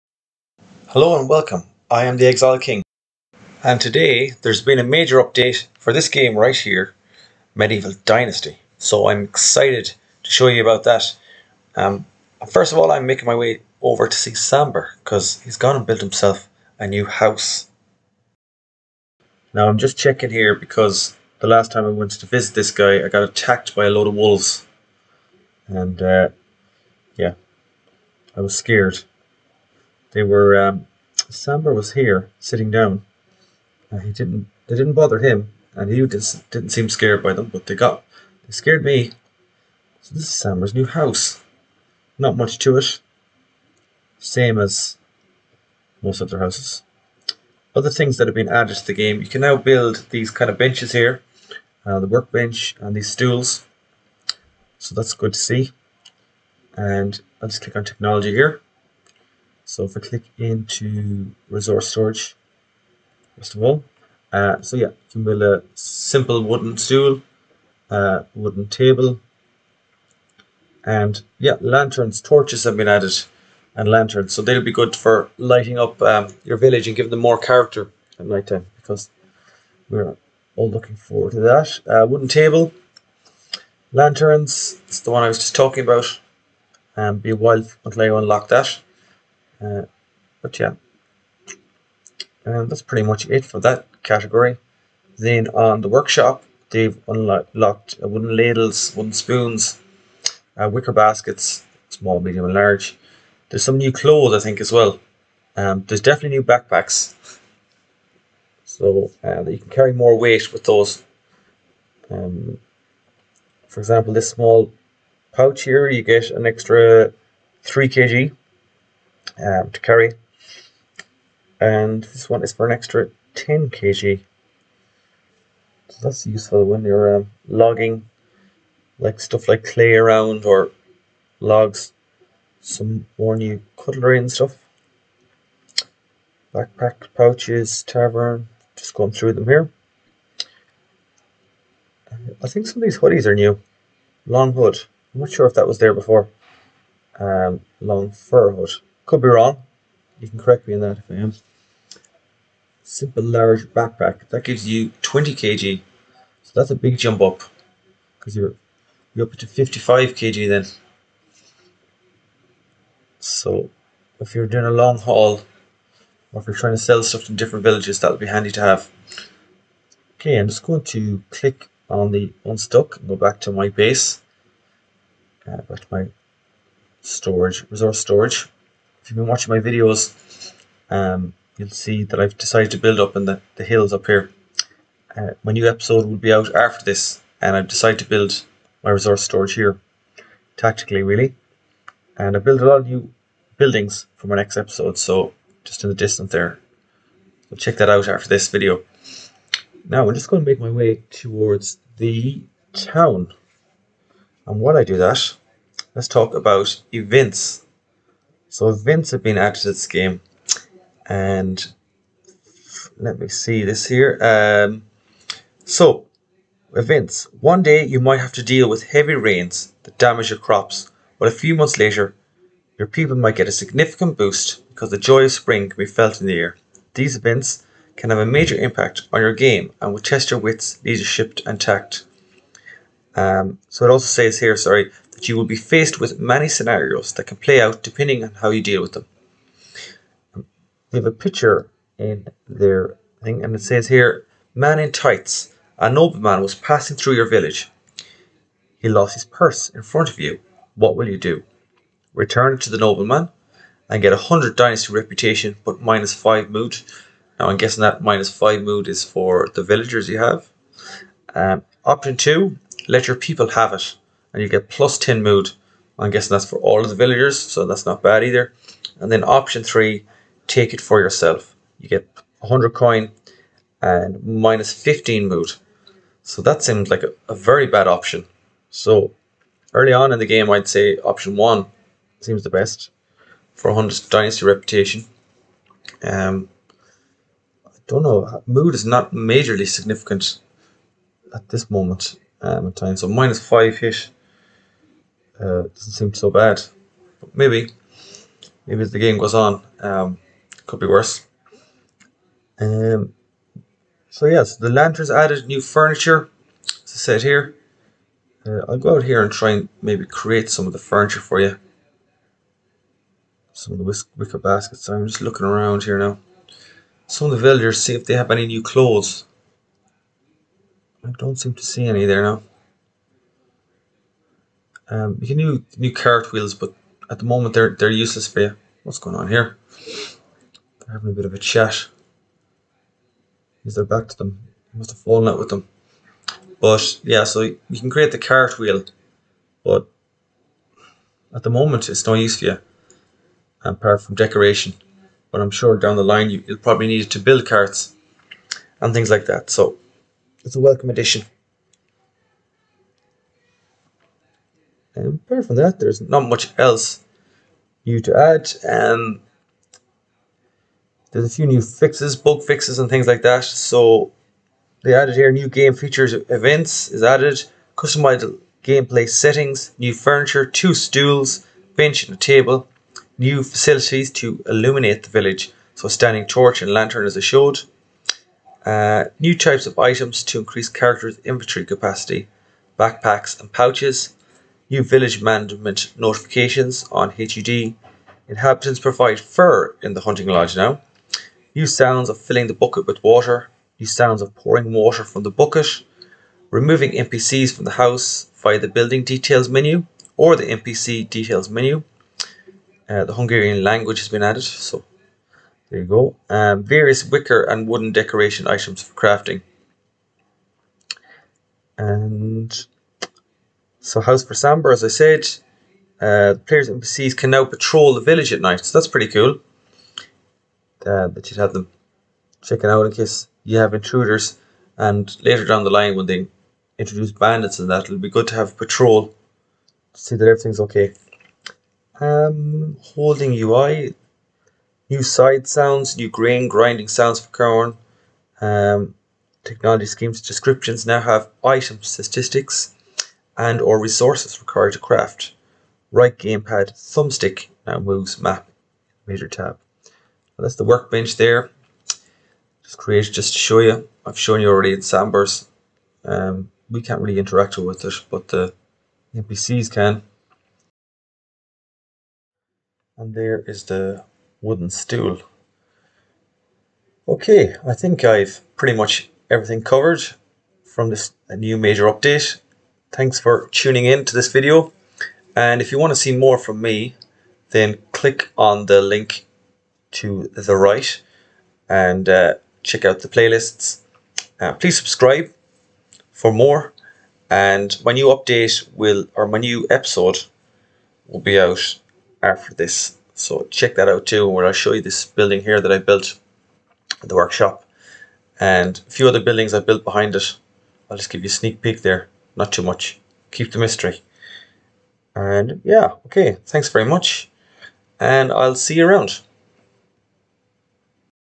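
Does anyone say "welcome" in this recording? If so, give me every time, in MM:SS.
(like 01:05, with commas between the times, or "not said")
00:01, 05:50.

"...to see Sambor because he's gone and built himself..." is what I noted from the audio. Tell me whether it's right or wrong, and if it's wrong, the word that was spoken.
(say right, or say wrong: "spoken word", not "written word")
right.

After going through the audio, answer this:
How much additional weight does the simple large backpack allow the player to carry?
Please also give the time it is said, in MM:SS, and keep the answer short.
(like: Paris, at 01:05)
20 kg, at 02:35.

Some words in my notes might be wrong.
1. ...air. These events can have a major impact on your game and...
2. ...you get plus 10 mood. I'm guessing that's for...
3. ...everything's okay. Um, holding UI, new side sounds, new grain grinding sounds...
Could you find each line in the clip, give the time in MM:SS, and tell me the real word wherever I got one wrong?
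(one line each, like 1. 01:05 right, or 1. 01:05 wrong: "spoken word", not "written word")
1. 03:46 right
2. 04:24 right
3. 07:10 right.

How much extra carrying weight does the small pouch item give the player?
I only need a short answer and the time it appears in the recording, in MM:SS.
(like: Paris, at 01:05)
3 kg, at 01:57.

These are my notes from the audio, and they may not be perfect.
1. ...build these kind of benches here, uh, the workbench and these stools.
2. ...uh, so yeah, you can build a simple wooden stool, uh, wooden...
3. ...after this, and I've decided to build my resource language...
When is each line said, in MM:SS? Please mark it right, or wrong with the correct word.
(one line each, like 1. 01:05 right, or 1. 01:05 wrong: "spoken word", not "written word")
1. 00:49 right
2. 01:04 right
3. 03:06 wrong: "storage", not "language".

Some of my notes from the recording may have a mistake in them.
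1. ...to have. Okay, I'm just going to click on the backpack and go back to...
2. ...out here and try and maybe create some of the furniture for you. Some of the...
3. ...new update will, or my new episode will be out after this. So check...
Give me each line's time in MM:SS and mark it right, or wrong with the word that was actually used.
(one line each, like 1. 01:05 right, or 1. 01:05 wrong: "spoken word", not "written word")
1. 02:48 wrong: "unstuck", not "backpack"
2. 05:08 right
3. 08:07 right.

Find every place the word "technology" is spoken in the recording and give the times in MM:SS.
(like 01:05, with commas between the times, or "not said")
00:57, 07:19.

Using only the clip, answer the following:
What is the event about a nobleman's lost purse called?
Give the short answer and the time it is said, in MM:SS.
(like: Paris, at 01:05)
Man in tights, at 04:04.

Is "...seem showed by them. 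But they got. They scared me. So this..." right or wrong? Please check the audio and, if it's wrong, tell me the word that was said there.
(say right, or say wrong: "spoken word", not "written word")
wrong: "scared", not "showed".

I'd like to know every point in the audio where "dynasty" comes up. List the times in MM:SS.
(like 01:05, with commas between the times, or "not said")
00:08, 04:14, 04:44.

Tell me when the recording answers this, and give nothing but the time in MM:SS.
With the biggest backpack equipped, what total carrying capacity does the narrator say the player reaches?
02:39.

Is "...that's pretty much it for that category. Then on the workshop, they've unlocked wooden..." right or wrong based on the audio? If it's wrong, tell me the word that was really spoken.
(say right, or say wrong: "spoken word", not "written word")
right.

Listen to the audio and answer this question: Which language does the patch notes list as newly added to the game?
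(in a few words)
Hungarian.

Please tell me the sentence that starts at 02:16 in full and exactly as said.
Backpack, pouches, tavern, just going through them here.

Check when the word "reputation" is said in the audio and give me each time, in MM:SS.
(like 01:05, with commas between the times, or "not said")
04:14, 04:44.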